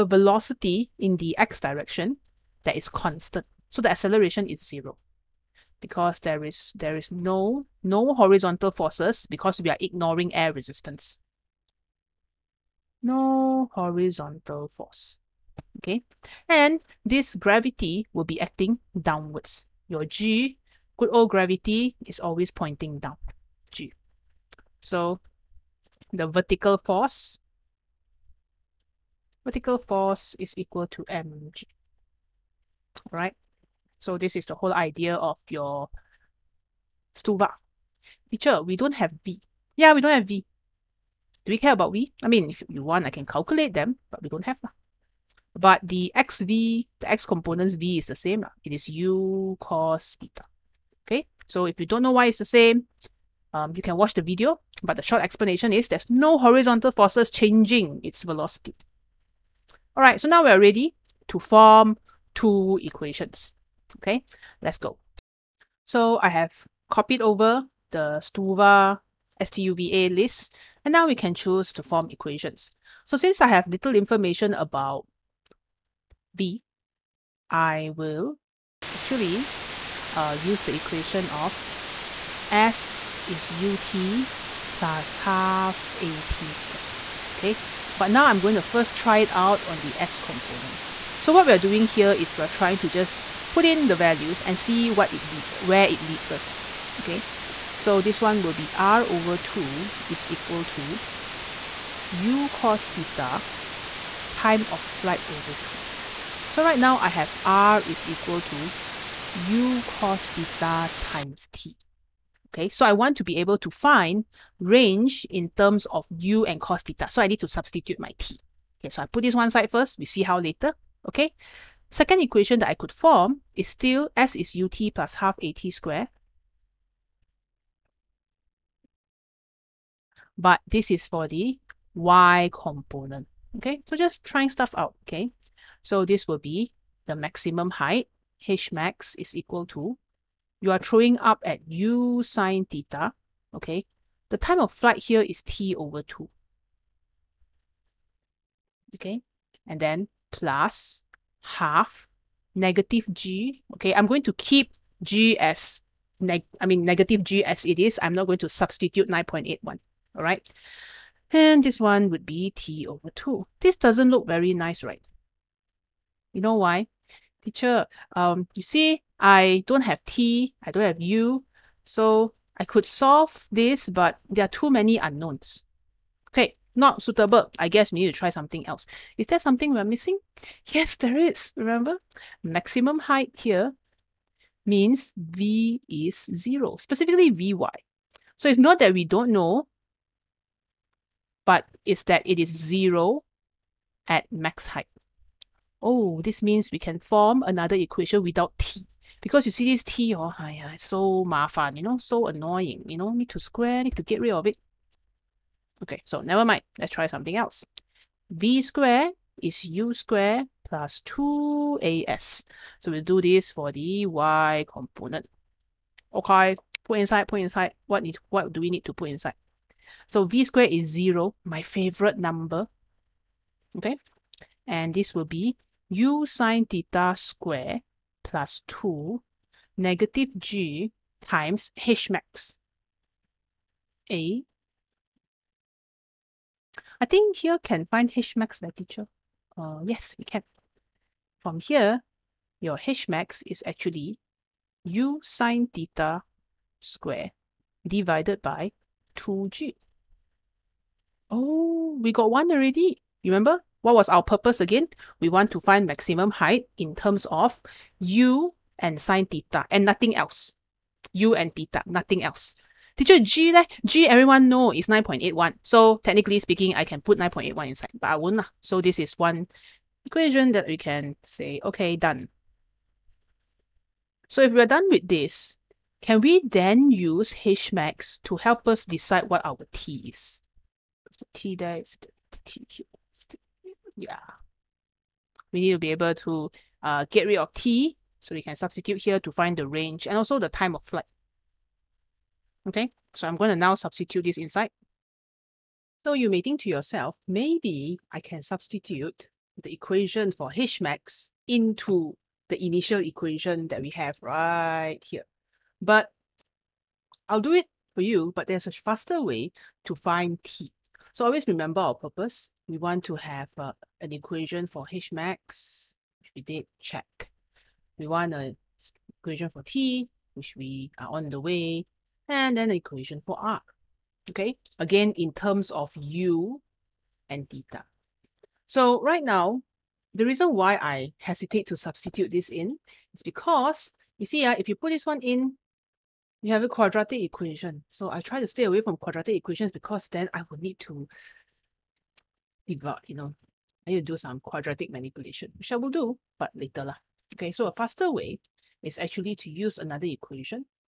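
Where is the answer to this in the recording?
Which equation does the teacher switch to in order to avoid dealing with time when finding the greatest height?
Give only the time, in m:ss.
3:28.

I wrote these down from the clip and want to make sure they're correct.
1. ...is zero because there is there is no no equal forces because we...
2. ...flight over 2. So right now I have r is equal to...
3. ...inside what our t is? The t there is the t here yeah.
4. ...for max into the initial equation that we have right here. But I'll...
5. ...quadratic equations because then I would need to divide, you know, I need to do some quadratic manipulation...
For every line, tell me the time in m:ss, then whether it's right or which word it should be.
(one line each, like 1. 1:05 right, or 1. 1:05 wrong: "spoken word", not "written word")
1. 0:04 wrong: "horizontal", not "equal"
2. 1:44 right
3. 4:38 wrong: "decide", not "inside"
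4. 5:00 right
5. 5:38 right.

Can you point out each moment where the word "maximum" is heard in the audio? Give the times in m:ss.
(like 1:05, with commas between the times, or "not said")
2:17, 3:02, 4:15.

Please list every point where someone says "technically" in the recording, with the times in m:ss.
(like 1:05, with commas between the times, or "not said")
4:26.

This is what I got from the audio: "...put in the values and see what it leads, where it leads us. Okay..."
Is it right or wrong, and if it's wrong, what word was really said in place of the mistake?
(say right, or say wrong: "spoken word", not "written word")
right.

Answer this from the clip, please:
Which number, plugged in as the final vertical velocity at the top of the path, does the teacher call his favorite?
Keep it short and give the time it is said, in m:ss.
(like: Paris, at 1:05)
0, at 3:40.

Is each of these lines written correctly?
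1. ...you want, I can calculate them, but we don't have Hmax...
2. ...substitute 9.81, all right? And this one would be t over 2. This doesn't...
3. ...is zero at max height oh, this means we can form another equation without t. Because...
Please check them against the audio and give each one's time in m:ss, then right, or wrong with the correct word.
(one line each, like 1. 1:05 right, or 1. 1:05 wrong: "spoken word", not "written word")
1. 0:42 wrong: "But", not "Hmax"
2. 2:38 right
3. 3:12 right.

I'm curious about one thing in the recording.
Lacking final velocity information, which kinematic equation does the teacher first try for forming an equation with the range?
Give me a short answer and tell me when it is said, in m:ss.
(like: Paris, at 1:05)
s = ut + ½at², at 1:22.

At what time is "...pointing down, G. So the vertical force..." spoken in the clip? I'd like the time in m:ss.
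0:22.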